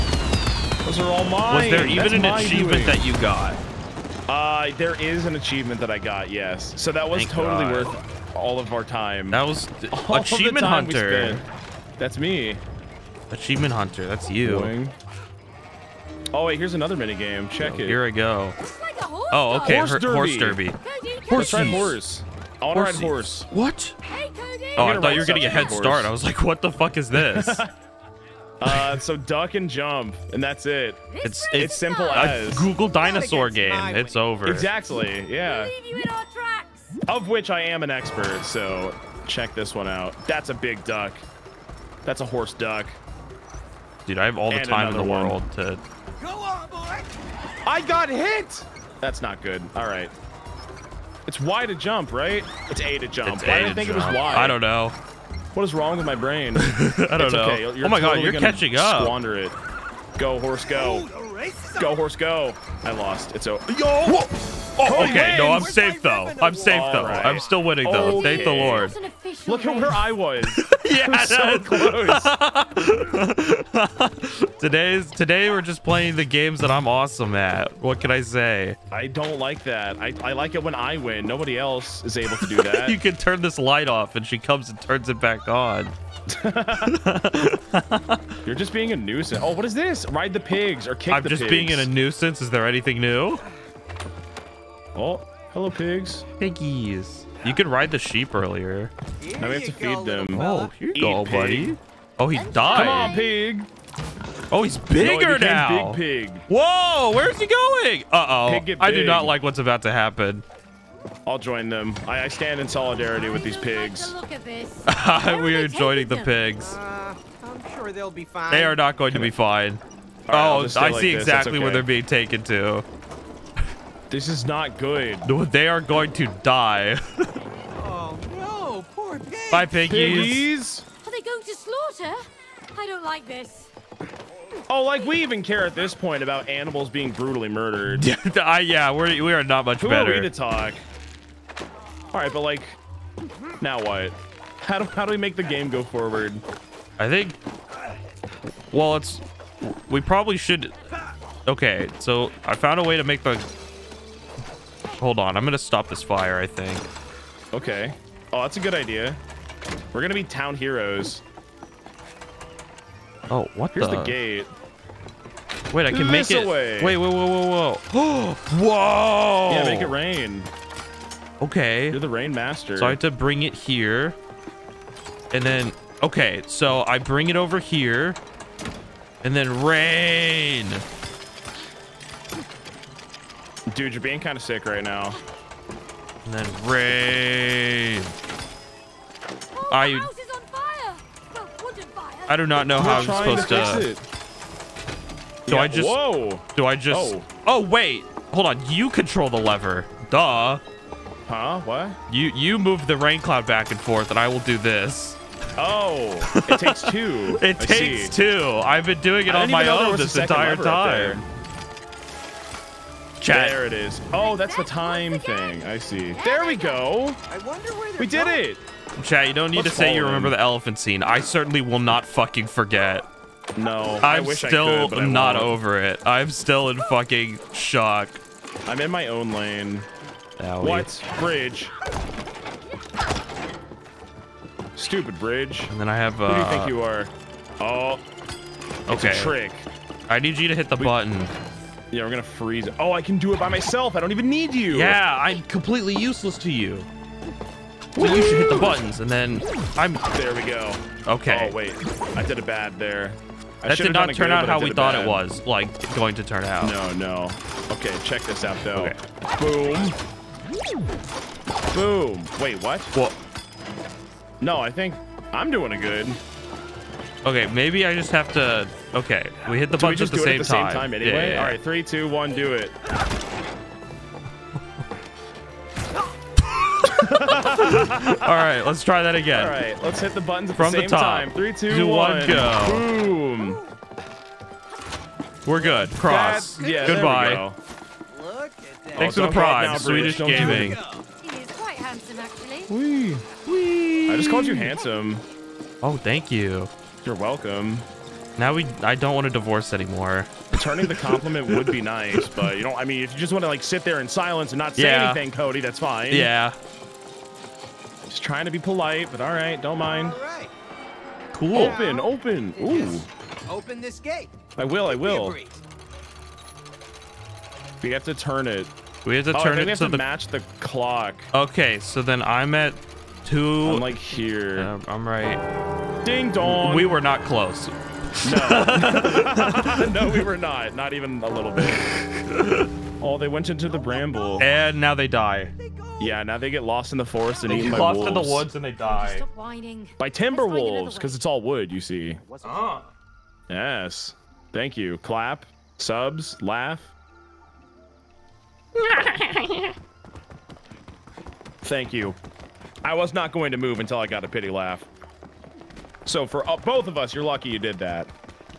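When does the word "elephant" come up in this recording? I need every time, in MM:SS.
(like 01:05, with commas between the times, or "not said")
03:40.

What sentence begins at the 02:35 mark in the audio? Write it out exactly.
I'm going to stop this fire, I think.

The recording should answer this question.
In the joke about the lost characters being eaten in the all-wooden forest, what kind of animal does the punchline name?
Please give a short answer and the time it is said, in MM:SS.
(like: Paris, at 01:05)
Timber wolves, at 05:40.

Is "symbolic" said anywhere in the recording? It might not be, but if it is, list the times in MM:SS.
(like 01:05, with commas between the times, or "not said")
not said.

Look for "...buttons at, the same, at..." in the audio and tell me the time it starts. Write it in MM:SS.
04:29.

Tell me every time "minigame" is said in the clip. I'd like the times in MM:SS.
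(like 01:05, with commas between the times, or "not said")
00:16.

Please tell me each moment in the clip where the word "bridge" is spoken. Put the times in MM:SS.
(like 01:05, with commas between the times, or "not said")
03:51, 03:55.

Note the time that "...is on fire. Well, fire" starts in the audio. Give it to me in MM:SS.
03:10.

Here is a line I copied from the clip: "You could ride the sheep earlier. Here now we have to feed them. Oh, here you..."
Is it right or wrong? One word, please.
right.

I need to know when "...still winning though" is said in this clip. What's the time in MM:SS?
01:07.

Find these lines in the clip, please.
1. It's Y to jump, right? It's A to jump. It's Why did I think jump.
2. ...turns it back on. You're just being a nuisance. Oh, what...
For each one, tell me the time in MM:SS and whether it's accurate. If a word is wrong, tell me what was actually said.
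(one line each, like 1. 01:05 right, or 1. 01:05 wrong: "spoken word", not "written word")
1. 00:51 right
2. 01:24 right.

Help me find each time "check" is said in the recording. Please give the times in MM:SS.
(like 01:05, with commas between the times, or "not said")
00:17, 00:39, 04:18.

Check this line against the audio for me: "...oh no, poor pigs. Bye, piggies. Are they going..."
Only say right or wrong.
right.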